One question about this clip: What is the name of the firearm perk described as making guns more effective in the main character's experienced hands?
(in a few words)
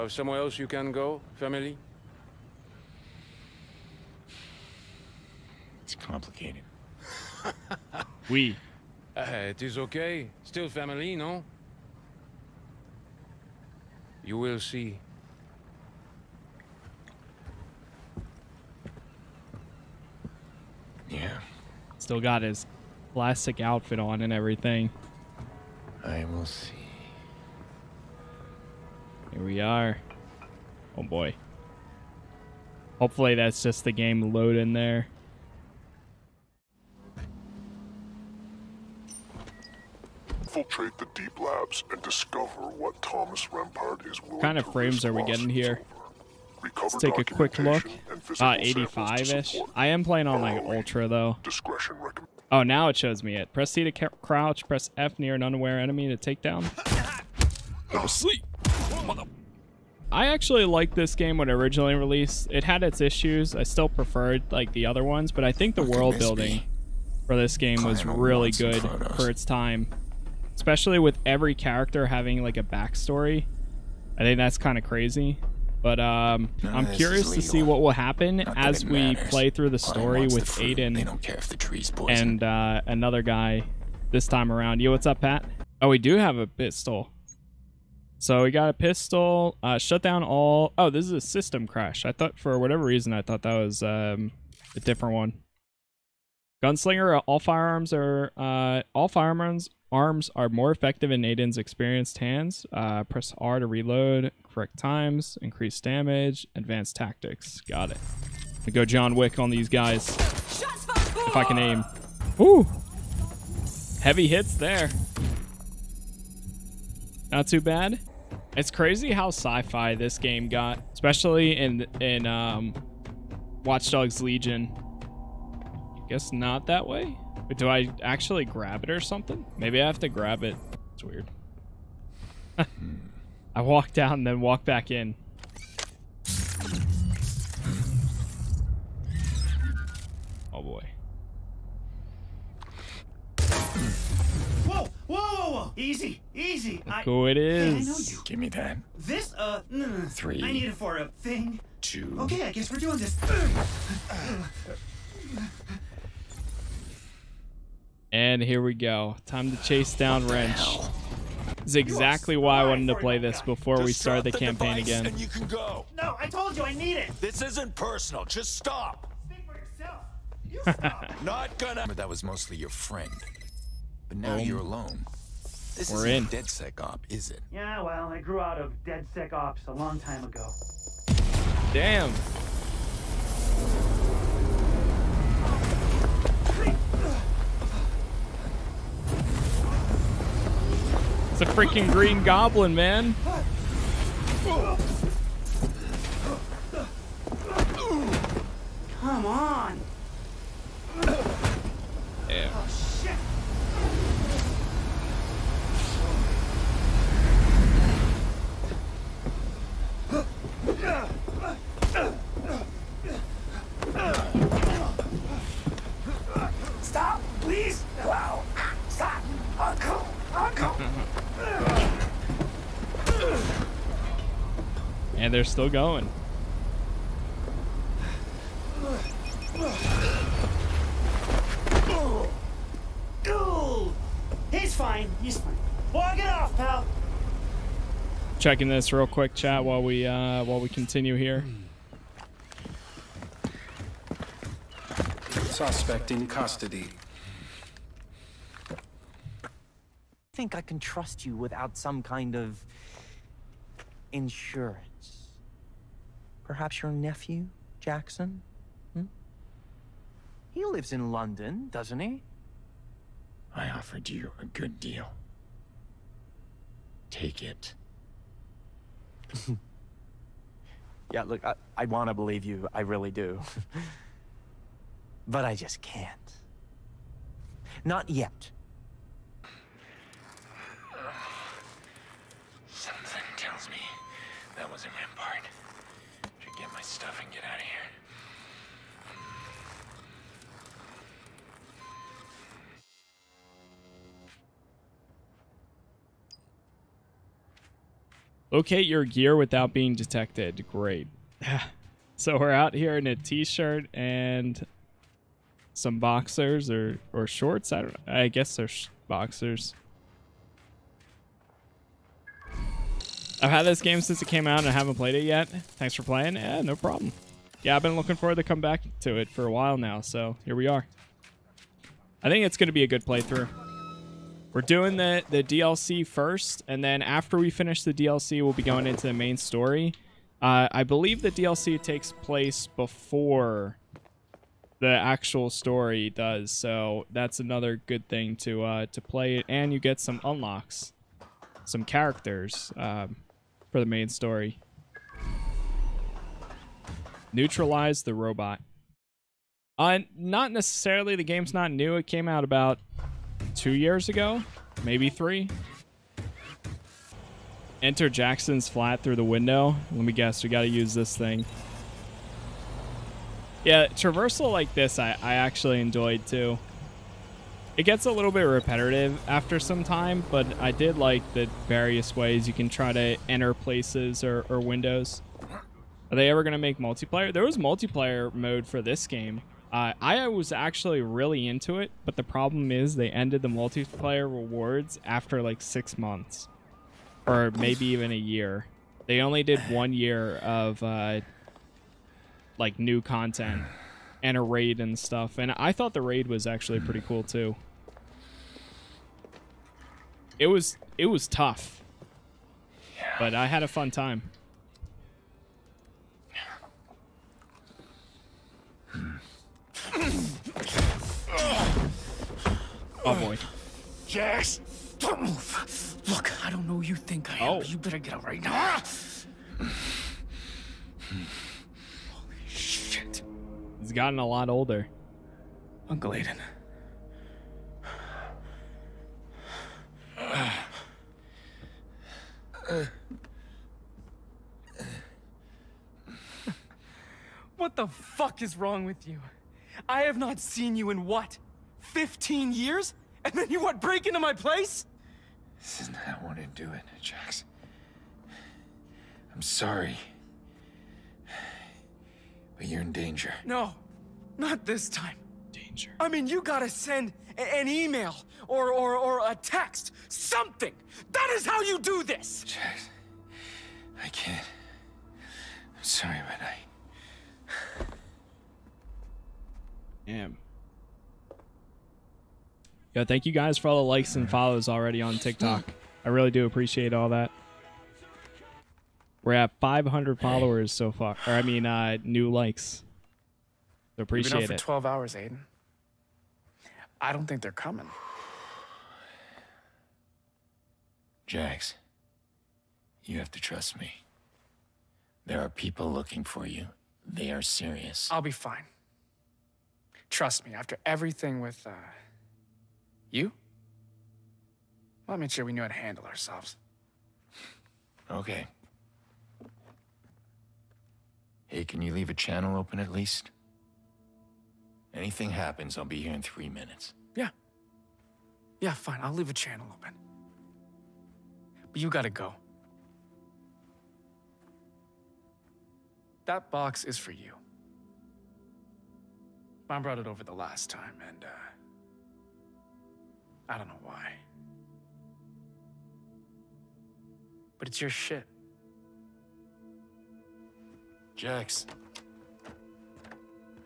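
Gunslinger.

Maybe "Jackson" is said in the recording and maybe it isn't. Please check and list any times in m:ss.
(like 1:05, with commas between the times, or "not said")
4:17, 5:58.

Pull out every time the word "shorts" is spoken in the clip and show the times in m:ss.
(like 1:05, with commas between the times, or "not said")
5:07.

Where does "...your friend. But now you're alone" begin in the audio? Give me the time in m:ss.
2:52.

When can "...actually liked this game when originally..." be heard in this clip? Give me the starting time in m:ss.
1:00.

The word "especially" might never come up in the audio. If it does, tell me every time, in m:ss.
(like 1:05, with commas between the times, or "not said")
1:10, 2:00.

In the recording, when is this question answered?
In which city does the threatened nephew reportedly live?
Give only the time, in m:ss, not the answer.
4:21.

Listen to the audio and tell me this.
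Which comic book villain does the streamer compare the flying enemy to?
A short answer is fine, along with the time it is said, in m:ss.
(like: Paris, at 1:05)
Green Goblin, at 3:11.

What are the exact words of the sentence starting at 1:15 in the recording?
But um, no, I'm curious to see what will happen Not as we matters.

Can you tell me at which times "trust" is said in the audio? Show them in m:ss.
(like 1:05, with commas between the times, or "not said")
4:10, 8:13, 8:20.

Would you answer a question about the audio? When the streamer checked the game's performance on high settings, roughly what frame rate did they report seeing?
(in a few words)
85.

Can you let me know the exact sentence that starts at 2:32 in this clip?
Okay, I guess we're doing this.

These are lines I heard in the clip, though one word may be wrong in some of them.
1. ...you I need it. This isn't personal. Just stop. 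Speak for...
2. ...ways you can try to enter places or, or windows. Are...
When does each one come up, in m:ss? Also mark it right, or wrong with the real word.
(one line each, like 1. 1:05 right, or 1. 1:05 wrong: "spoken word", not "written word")
1. 2:46 right
2. 6:12 right.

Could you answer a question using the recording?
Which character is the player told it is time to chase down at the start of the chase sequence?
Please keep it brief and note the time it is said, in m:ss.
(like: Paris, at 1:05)
Wrench, at 2:40.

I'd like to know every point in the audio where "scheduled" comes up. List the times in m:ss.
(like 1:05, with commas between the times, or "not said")
not said.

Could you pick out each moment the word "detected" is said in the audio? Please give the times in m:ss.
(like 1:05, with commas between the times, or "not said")
4:59.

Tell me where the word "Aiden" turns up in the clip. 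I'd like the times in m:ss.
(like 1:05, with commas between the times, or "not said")
1:20, 1:41, 7:06, 8:05.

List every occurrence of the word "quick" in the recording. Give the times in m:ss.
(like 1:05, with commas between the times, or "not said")
0:47, 3:59.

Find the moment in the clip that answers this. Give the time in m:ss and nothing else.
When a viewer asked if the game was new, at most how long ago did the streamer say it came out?
5:54.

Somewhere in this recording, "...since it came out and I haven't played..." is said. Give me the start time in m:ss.
5:14.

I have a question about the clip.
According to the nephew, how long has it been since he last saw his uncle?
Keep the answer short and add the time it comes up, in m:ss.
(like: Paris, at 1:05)
15 years, at 7:21.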